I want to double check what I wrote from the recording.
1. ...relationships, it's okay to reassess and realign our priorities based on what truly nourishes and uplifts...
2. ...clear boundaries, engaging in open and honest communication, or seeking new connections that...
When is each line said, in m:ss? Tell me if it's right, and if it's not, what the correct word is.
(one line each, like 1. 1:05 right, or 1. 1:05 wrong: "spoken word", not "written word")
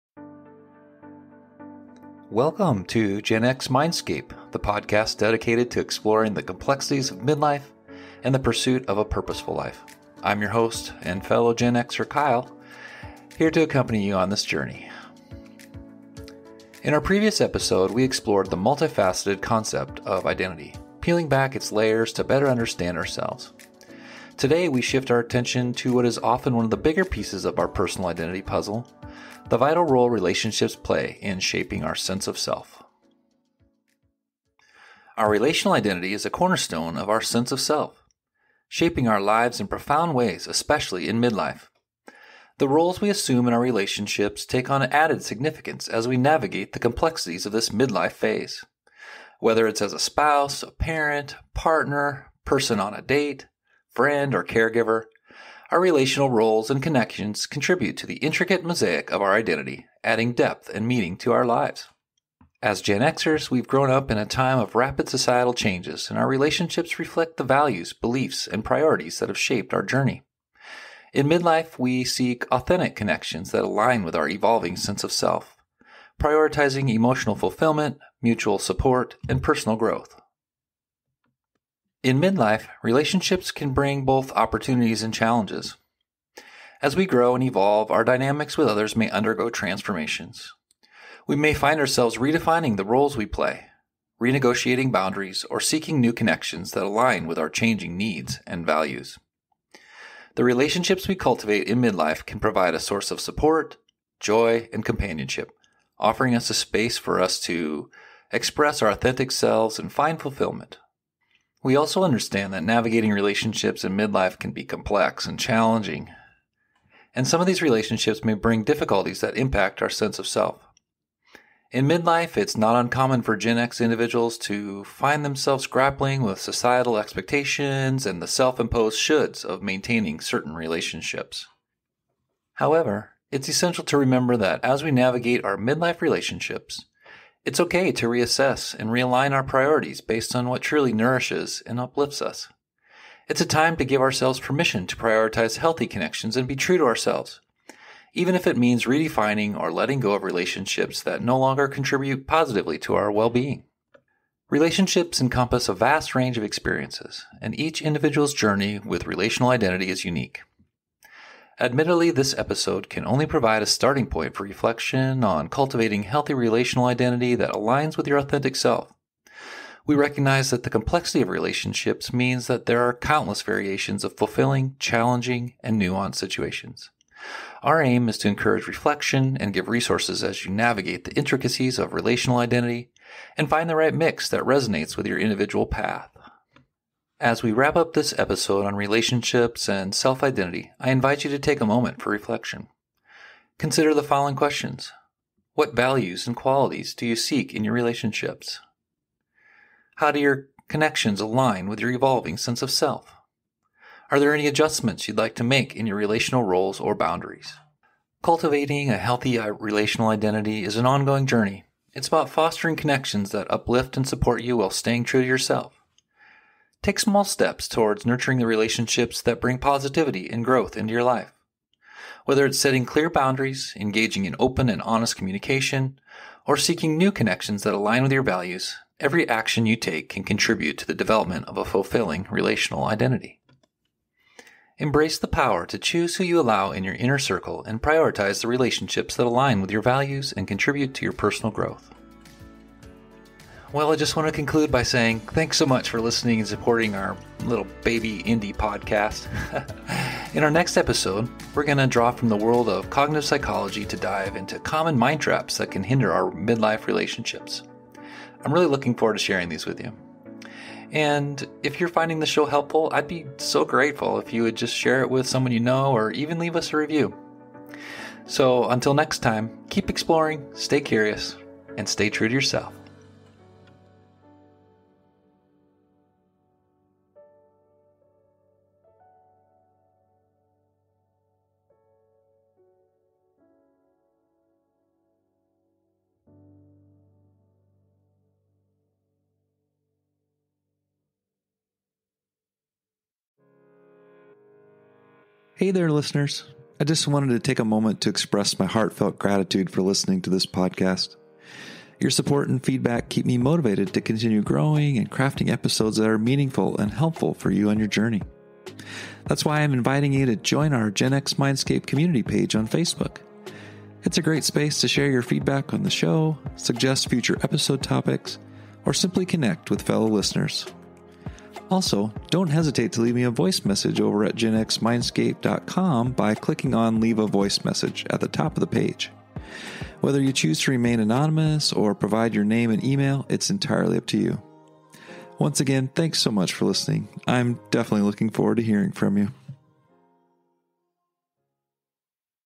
1. 2:16 right
2. 3:42 right.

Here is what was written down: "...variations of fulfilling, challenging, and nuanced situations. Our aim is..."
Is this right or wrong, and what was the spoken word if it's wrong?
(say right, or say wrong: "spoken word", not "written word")
right.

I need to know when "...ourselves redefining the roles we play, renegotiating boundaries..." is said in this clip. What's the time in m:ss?
1:31.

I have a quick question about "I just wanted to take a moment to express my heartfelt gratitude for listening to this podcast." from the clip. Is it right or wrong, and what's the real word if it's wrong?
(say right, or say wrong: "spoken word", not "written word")
right.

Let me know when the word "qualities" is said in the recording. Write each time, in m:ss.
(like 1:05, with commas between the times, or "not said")
3:16.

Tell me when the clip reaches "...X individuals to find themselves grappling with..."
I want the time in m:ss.
2:03.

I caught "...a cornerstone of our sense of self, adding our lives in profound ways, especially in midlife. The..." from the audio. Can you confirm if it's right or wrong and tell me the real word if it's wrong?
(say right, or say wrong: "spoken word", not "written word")
wrong: "shaping", not "adding".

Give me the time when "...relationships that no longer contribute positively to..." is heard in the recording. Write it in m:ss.
2:30.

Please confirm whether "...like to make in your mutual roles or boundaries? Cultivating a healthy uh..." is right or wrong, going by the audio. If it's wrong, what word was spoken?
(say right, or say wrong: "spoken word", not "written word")
wrong: "relational", not "mutual".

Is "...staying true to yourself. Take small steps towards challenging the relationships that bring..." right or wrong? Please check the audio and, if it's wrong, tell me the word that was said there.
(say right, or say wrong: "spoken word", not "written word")
wrong: "nurturing", not "challenging".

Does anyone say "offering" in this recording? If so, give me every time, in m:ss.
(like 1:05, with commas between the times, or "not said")
1:45.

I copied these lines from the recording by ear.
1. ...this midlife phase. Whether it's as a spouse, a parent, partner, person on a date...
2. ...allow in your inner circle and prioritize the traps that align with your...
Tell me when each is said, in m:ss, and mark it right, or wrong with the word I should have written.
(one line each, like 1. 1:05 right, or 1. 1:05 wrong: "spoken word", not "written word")
1. 0:47 right
2. 3:56 wrong: "relationships", not "traps".